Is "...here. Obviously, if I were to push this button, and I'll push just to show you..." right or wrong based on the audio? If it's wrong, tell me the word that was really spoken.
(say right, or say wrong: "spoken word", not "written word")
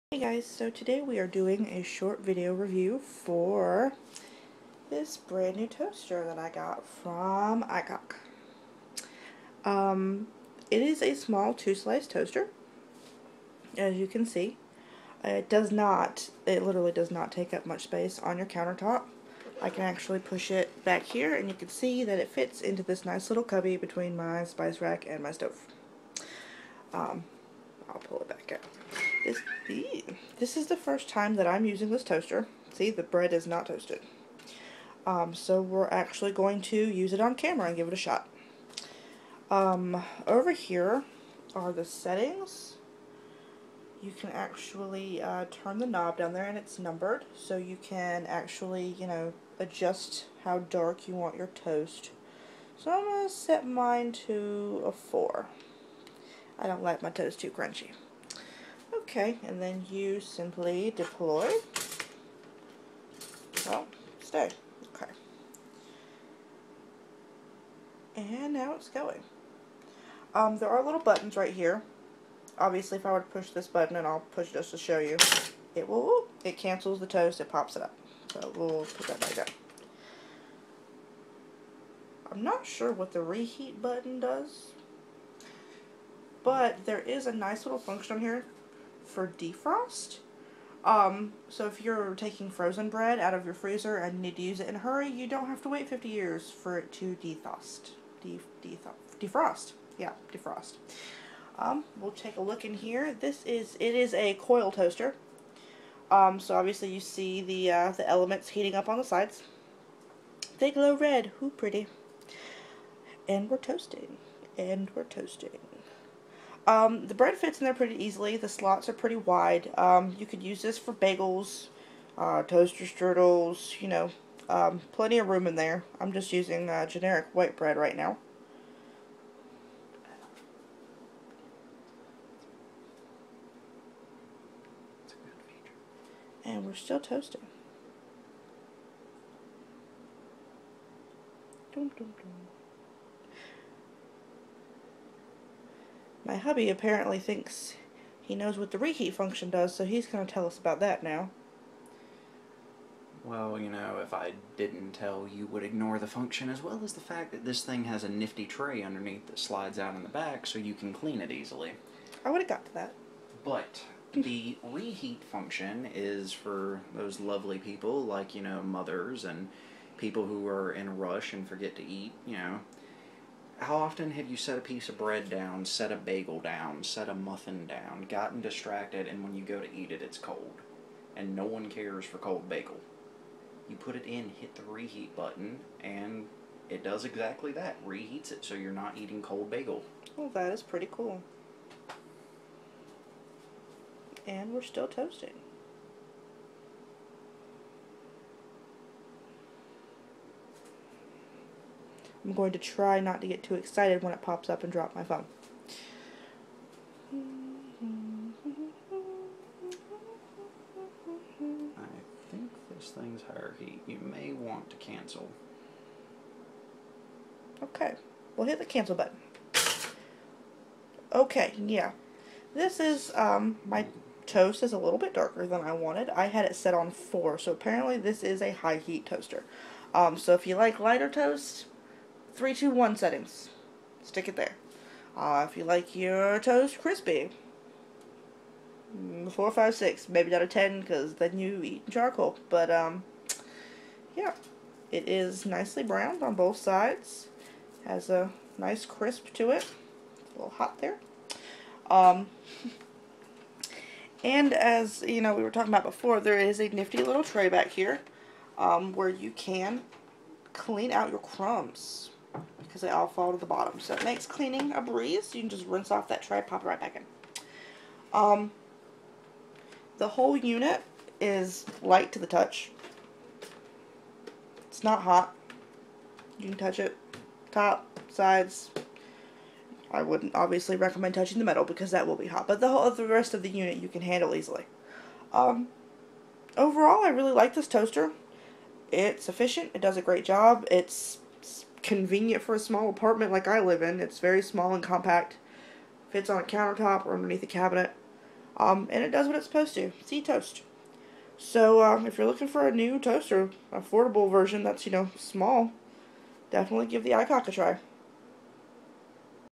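right.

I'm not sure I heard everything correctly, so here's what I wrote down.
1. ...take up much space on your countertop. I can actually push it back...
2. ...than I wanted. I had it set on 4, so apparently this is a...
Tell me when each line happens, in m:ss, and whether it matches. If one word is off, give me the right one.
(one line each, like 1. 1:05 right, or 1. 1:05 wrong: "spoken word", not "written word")
1. 0:17 right
2. 3:45 right.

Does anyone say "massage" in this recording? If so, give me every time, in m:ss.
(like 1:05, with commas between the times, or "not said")
not said.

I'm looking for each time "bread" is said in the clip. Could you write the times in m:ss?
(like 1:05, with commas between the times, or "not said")
0:33, 1:32, 1:57, 2:07, 2:54.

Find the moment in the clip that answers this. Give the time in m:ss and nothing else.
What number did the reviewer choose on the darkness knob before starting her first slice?
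0:53.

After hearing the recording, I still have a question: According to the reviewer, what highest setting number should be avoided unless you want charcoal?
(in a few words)
10.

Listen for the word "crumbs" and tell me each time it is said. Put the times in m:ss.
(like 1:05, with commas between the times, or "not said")
4:21.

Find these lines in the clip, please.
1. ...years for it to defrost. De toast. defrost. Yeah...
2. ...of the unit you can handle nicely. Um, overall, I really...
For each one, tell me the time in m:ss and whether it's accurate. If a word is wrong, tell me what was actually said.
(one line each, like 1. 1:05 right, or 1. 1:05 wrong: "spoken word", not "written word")
1. 1:36 wrong: "defrost", not "toast"
2. 4:43 wrong: "easily", not "nicely".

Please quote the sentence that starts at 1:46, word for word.
Um, so obviously you see the, uh, the elements heating up on the sides.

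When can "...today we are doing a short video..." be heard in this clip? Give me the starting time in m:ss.
0:00.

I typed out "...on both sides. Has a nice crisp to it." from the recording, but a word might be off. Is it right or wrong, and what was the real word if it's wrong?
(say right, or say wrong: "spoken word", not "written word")
right.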